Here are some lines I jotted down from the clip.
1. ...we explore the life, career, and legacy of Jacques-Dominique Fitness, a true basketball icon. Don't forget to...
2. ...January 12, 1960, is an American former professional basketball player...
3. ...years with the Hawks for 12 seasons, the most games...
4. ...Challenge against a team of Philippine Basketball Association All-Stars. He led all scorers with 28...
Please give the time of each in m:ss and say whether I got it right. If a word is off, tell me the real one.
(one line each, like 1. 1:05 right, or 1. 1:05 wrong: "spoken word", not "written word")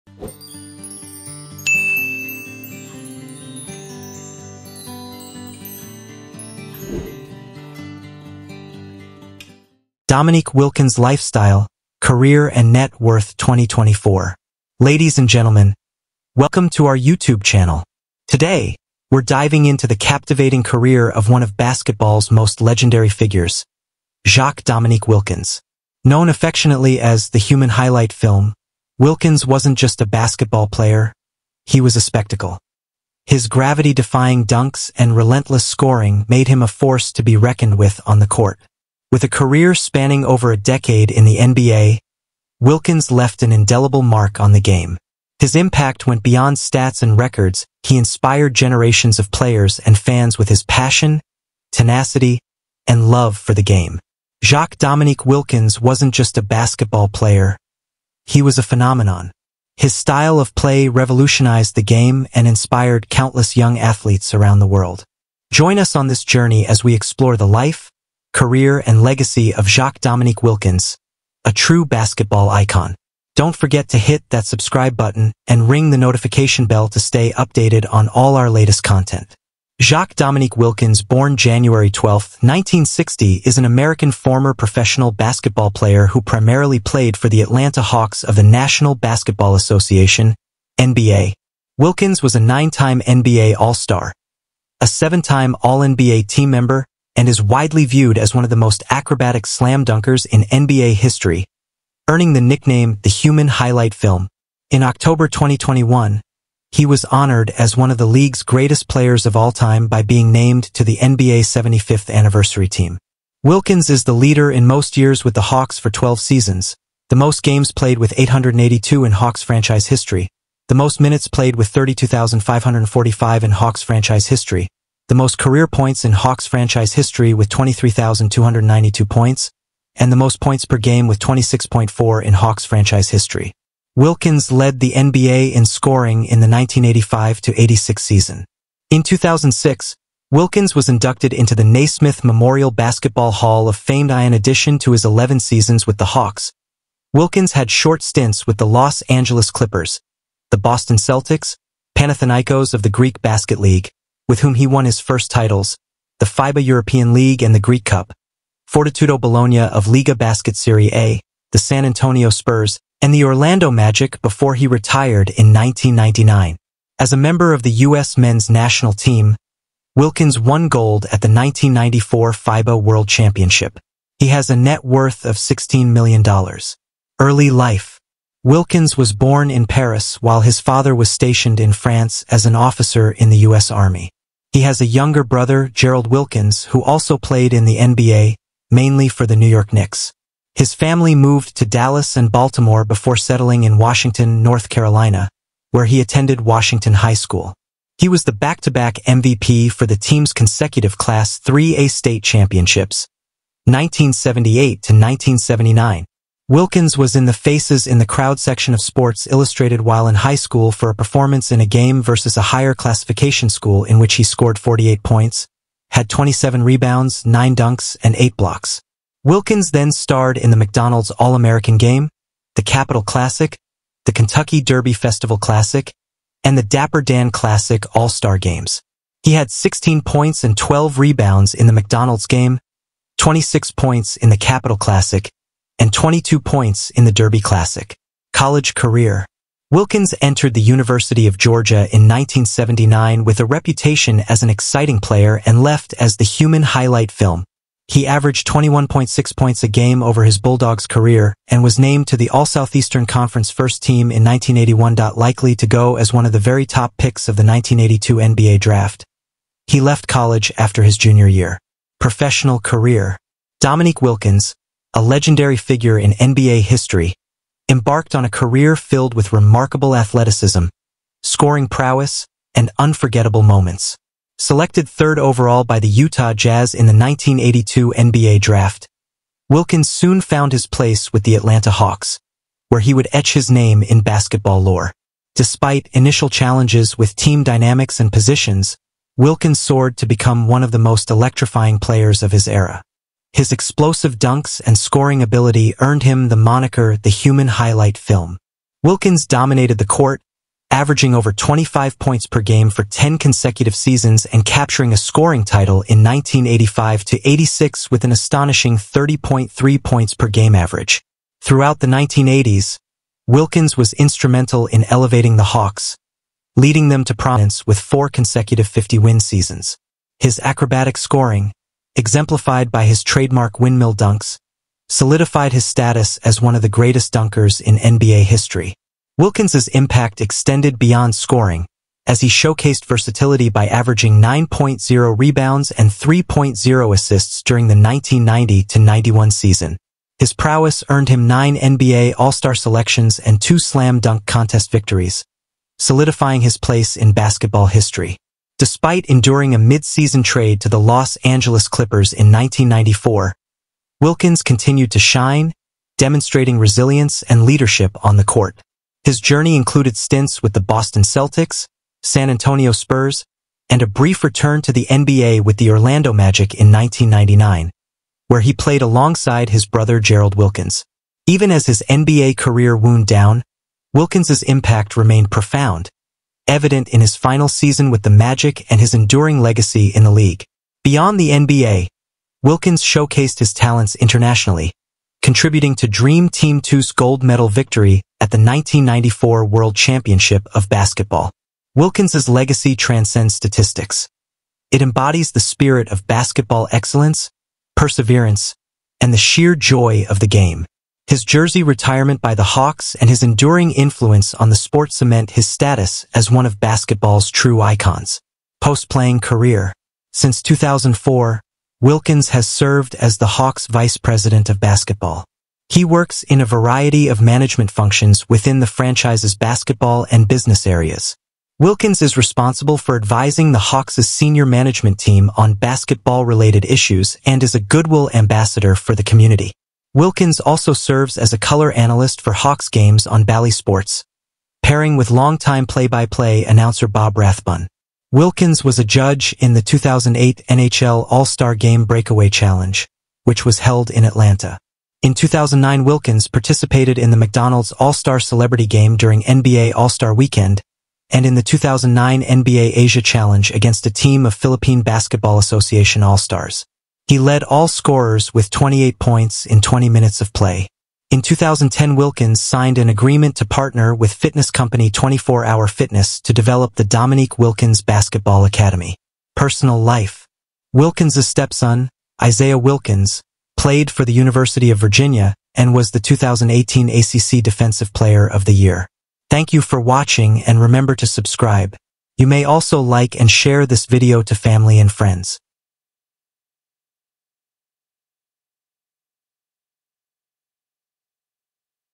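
1. 1:06 wrong: "Wilkins", not "Fitness"
2. 1:21 right
3. 1:54 right
4. 7:33 right.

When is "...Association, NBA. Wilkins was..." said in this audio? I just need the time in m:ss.
1:29.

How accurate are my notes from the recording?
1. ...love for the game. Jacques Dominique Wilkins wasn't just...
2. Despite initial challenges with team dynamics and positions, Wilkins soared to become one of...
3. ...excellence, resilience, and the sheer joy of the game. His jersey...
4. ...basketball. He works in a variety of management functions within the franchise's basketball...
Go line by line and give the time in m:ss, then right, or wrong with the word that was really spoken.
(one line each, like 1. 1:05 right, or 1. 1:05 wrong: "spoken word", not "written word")
1. 0:53 right
2. 4:45 right
3. 6:36 wrong: "perseverance", not "resilience"
4. 6:54 right.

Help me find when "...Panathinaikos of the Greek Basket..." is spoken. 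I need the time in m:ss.
2:31.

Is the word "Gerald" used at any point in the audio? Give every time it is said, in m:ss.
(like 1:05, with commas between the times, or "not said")
3:05, 6:09.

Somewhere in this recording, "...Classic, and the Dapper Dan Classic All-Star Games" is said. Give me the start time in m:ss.
3:45.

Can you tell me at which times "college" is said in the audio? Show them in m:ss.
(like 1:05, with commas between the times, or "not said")
3:58, 4:20.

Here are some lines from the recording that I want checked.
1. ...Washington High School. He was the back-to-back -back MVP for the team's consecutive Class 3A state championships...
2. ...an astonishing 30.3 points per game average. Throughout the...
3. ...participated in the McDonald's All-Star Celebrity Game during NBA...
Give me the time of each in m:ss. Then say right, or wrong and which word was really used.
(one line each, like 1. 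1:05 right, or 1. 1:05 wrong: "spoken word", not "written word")
1. 3:16 right
2. 5:08 right
3. 7:26 right.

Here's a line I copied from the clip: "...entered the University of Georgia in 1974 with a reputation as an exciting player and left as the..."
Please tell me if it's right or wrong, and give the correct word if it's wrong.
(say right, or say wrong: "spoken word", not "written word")
wrong: "1979", not "1974".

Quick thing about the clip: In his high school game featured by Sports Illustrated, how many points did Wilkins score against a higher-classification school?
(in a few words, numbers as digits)
48.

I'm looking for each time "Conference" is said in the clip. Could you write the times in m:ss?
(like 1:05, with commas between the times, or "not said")
4:13.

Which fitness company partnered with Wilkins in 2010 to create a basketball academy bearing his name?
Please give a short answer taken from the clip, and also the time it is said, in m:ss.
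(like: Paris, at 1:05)
24 Hour Fitness, at 7:44.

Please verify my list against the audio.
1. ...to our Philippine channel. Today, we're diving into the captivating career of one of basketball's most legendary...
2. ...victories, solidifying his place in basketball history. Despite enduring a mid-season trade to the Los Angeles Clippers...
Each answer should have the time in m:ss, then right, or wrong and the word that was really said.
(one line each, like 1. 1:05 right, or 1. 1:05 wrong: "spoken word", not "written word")
1. 0:16 wrong: "YouTube", not "Philippine"
2. 5:44 right.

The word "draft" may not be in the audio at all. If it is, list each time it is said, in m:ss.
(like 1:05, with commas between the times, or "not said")
4:18, 4:38.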